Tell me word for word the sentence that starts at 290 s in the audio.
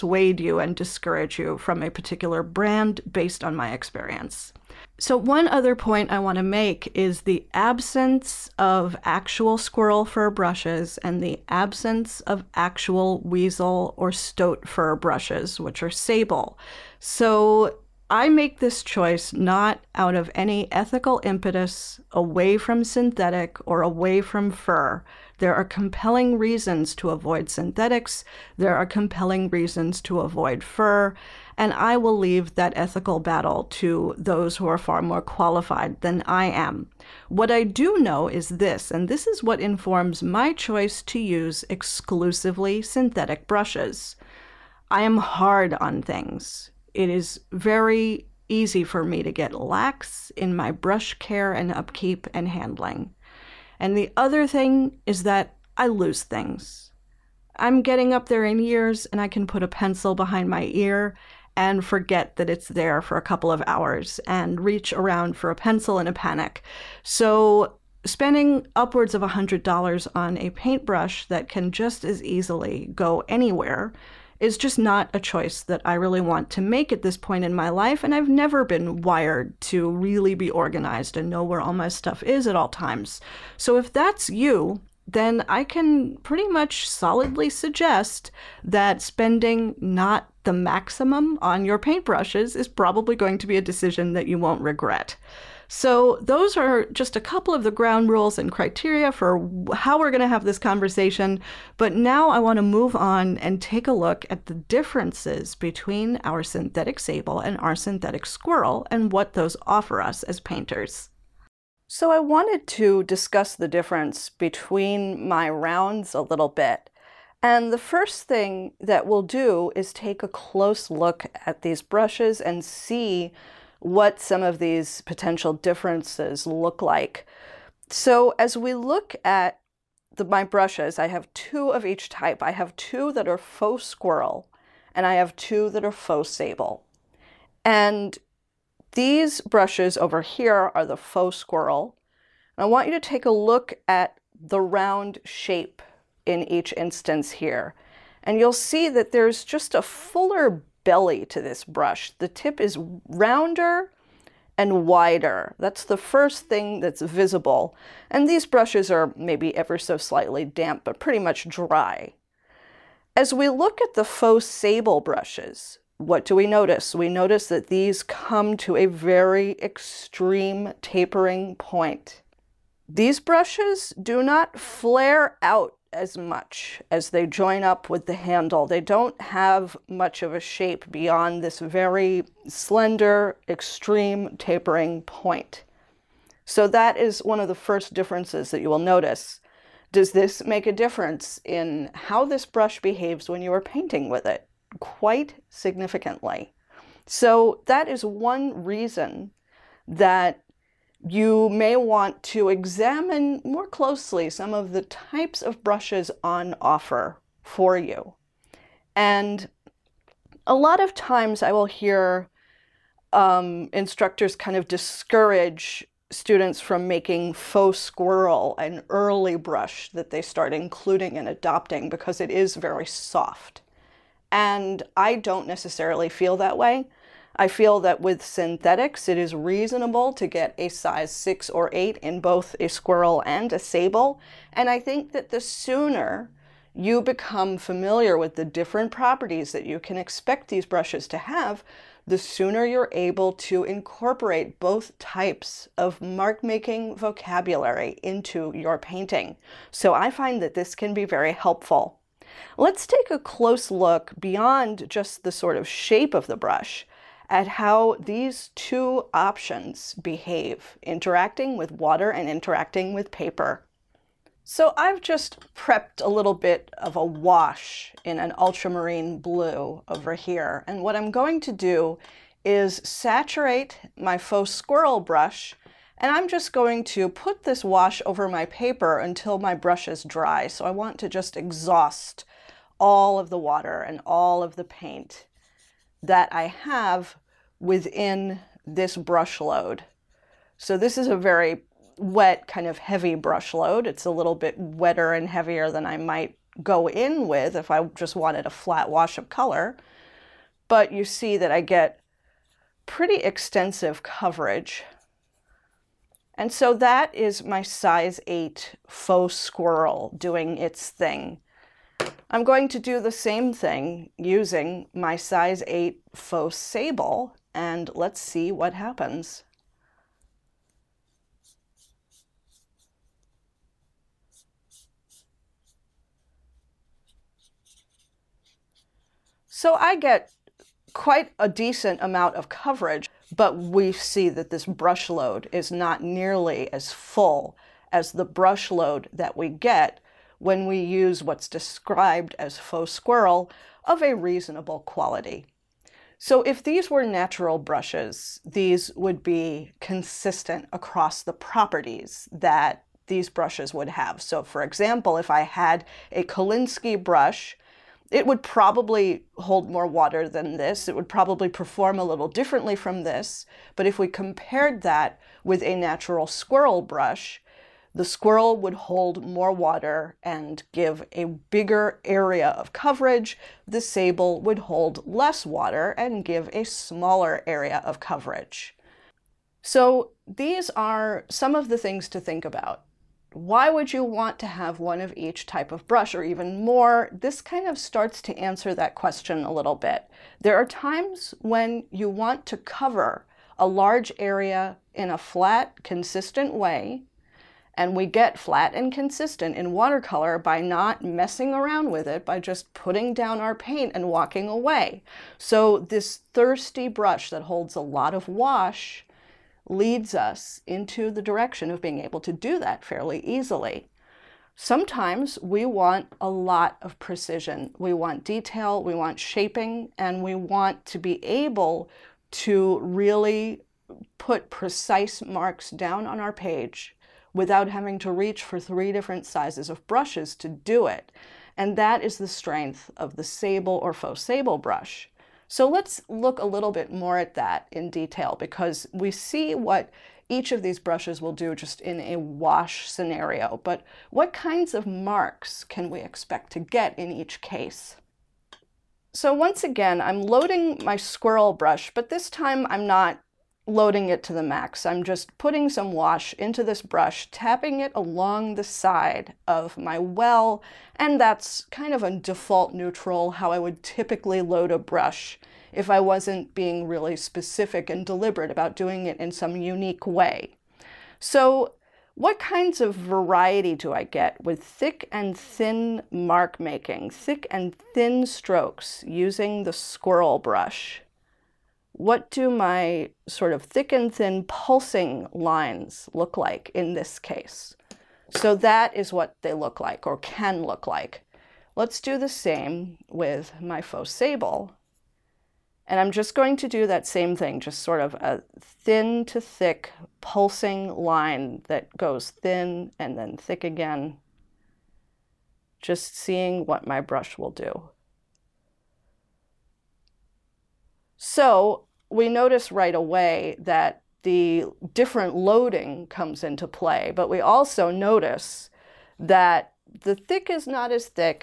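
So this is a very wet kind of heavy brush load.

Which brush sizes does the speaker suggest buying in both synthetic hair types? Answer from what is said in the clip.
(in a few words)
6 or 8.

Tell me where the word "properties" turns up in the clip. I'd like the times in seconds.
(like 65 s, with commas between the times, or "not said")
238 s, 351 s.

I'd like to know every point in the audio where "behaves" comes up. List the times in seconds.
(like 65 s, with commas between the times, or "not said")
192 s, 260 s.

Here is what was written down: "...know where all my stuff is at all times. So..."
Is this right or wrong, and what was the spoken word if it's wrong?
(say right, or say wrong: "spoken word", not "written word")
right.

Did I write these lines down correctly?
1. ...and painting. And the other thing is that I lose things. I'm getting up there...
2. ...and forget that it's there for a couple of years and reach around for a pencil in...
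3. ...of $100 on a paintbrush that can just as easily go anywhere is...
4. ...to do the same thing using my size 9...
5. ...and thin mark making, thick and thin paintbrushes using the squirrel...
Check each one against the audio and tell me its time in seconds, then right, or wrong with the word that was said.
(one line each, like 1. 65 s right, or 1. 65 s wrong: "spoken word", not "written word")
1. 52 s wrong: "handling", not "painting"
2. 61 s wrong: "hours", not "years"
3. 69 s right
4. 312 s wrong: "8", not "9"
5. 475 s wrong: "strokes", not "paintbrushes".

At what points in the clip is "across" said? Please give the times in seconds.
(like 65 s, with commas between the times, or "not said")
350 s.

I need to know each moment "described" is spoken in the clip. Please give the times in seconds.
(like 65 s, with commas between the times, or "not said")
341 s.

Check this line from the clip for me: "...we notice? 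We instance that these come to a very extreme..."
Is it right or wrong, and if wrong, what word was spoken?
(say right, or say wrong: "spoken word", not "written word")
wrong: "notice", not "instance".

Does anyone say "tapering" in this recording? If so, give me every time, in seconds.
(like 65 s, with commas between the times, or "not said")
170 s, 184 s.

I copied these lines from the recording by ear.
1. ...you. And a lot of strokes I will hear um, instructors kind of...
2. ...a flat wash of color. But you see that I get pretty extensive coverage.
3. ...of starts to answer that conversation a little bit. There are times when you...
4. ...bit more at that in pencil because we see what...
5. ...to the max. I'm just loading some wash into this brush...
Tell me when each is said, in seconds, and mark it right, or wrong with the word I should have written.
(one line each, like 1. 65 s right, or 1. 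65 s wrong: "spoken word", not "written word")
1. 207 s wrong: "times", not "strokes"
2. 298 s right
3. 387 s wrong: "question", not "conversation"
4. 436 s wrong: "detail", not "pencil"
5. 454 s wrong: "putting", not "loading".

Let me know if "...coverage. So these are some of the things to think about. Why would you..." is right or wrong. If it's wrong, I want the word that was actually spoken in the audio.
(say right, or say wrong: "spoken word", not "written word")
right.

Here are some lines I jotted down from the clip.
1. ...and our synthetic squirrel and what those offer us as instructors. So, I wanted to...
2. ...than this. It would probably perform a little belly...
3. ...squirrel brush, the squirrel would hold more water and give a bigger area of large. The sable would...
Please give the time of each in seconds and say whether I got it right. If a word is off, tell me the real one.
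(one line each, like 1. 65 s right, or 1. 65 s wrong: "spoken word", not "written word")
1. 107 s wrong: "painters", not "instructors"
2. 360 s wrong: "differently", not "belly"
3. 366 s wrong: "coverage", not "large".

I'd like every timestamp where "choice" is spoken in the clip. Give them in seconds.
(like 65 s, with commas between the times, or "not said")
18 s, 40 s, 75 s.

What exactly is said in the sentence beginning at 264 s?
So I've just prepped a little bit of a wash in an ultramarine blue over here.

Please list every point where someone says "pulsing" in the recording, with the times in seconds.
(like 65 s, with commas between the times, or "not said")
484 s, 500 s.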